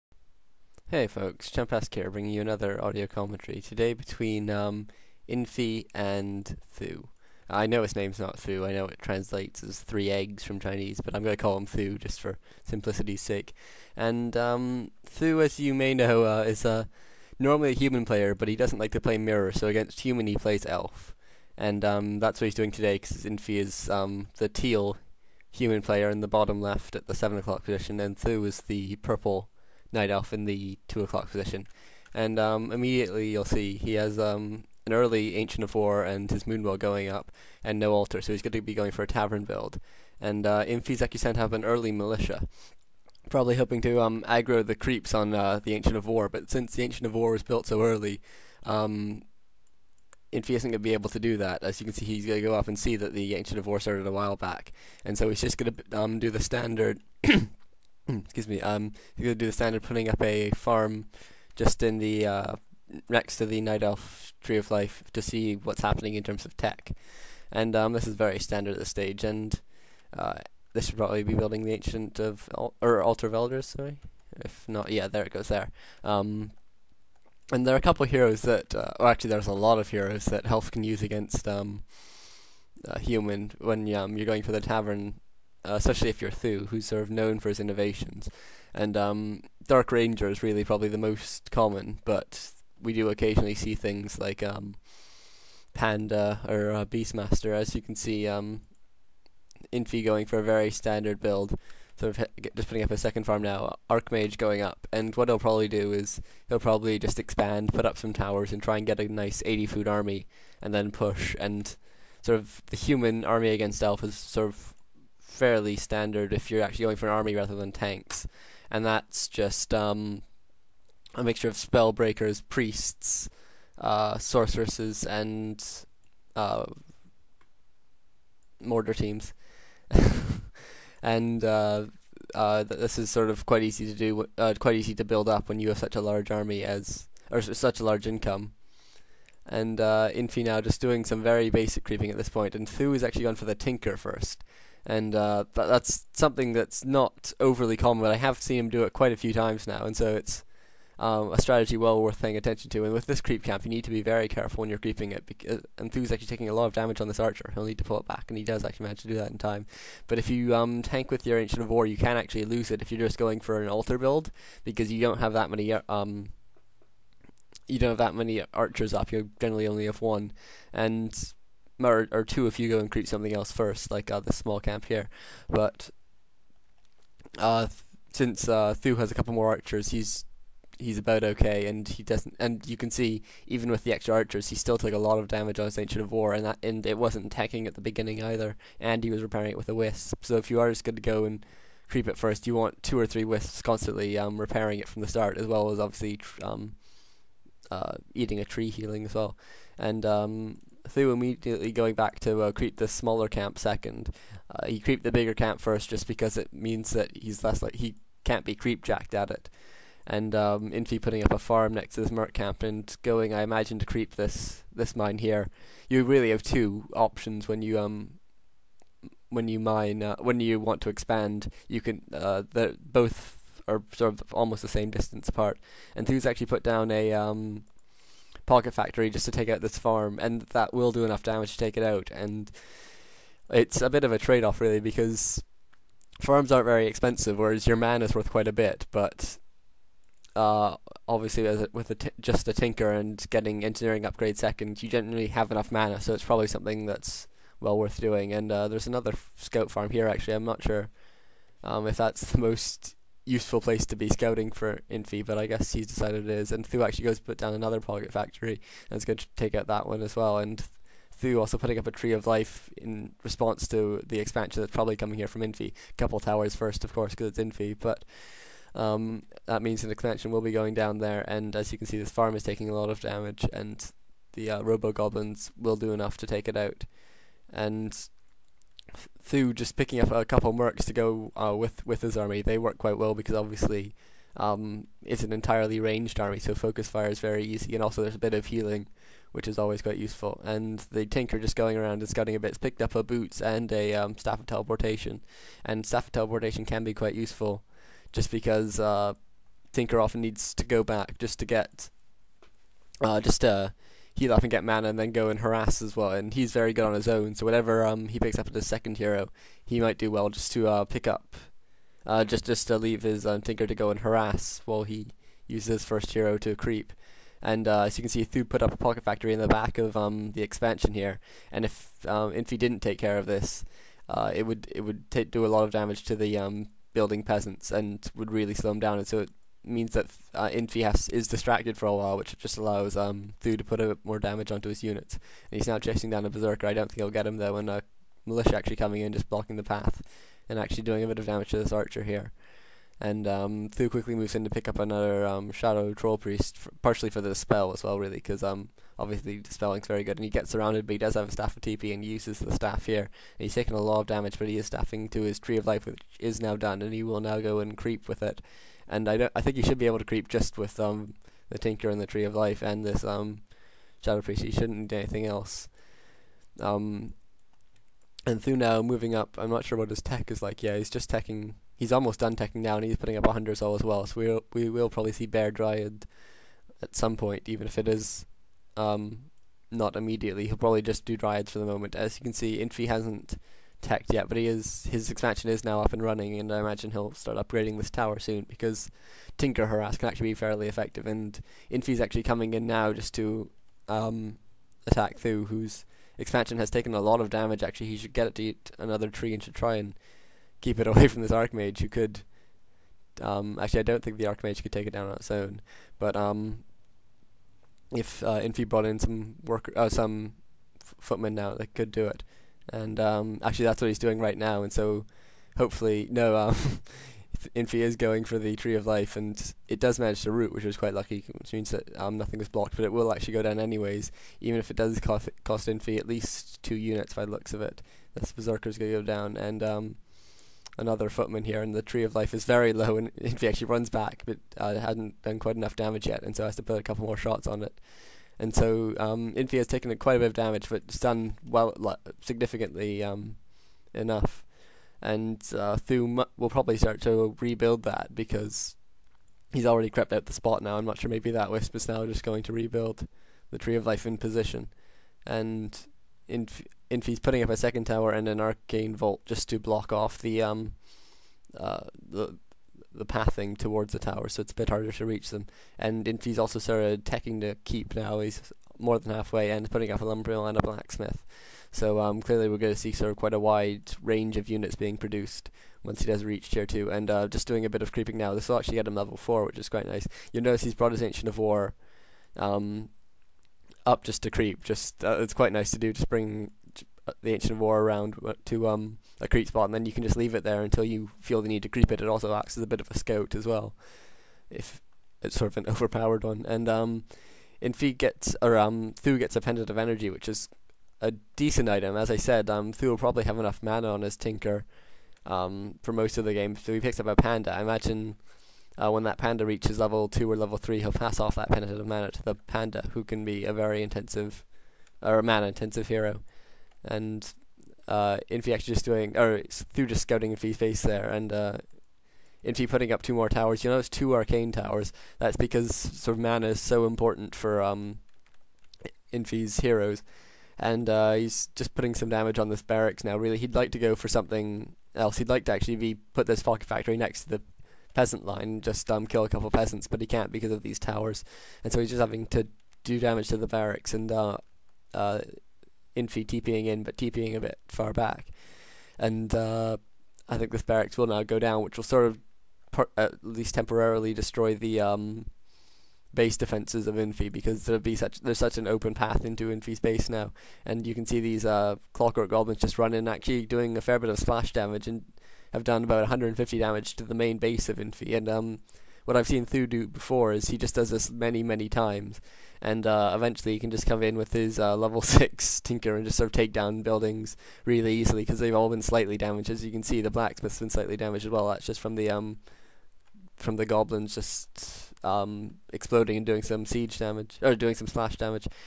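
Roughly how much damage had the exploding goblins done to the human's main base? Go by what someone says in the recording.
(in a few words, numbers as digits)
150.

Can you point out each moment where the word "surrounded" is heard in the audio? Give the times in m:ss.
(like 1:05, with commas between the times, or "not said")
5:50.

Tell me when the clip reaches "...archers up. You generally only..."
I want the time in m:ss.
2:48.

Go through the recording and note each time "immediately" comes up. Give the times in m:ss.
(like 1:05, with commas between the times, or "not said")
0:32, 3:21, 6:19.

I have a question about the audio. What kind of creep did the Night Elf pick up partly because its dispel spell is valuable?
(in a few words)
Shadow Troll Priest.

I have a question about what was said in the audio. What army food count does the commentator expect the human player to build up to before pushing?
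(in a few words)
80.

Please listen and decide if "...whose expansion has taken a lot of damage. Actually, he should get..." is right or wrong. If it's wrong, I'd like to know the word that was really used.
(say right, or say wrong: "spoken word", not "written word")
right.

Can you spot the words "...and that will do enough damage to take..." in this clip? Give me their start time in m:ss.
3:50.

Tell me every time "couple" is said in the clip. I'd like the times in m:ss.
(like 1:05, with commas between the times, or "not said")
1:17, 2:59, 4:25, 4:40, 7:16, 8:59.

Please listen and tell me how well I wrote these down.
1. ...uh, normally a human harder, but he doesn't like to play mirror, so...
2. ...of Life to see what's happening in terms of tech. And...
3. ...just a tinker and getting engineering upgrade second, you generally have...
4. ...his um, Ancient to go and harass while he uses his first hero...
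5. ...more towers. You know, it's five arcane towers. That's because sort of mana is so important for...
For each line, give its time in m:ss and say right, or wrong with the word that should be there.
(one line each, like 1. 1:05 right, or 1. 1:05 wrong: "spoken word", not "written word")
1. 0:16 wrong: "player", not "harder"
2. 1:04 right
3. 4:02 right
4. 5:13 wrong: "Tinker", not "Ancient"
5. 8:43 wrong: "two", not "five".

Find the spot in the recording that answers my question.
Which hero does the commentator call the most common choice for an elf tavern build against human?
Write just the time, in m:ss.
1:29.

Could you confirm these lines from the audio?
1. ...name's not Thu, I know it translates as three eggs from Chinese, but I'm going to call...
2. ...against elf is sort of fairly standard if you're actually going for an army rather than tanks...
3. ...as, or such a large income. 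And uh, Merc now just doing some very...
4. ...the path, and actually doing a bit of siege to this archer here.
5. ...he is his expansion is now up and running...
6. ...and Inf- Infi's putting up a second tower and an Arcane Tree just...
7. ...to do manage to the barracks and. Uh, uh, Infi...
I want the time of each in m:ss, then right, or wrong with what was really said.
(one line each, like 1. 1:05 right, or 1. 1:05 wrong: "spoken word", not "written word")
1. 0:07 right
2. 1:53 right
3. 2:16 wrong: "Infi", not "Merc"
4. 5:39 wrong: "damage", not "siege"
5. 6:24 right
6. 7:35 wrong: "Vault", not "Tree"
7. 9:02 wrong: "damage", not "manage".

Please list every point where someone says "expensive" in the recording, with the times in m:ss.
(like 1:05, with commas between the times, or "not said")
3:56.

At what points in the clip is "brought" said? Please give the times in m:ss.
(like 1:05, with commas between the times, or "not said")
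6:48, 8:00.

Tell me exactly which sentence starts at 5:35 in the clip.
And he's now chasing down a Berserker.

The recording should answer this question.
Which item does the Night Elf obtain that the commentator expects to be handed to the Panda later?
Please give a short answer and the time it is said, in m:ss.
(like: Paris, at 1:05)
pendant of energy, at 8:19.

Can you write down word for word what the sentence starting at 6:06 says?
Um, and Thu now moving up, I'm not sure what his tech is like.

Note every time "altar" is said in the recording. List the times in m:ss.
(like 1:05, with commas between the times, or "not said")
0:37, 1:13, 2:43.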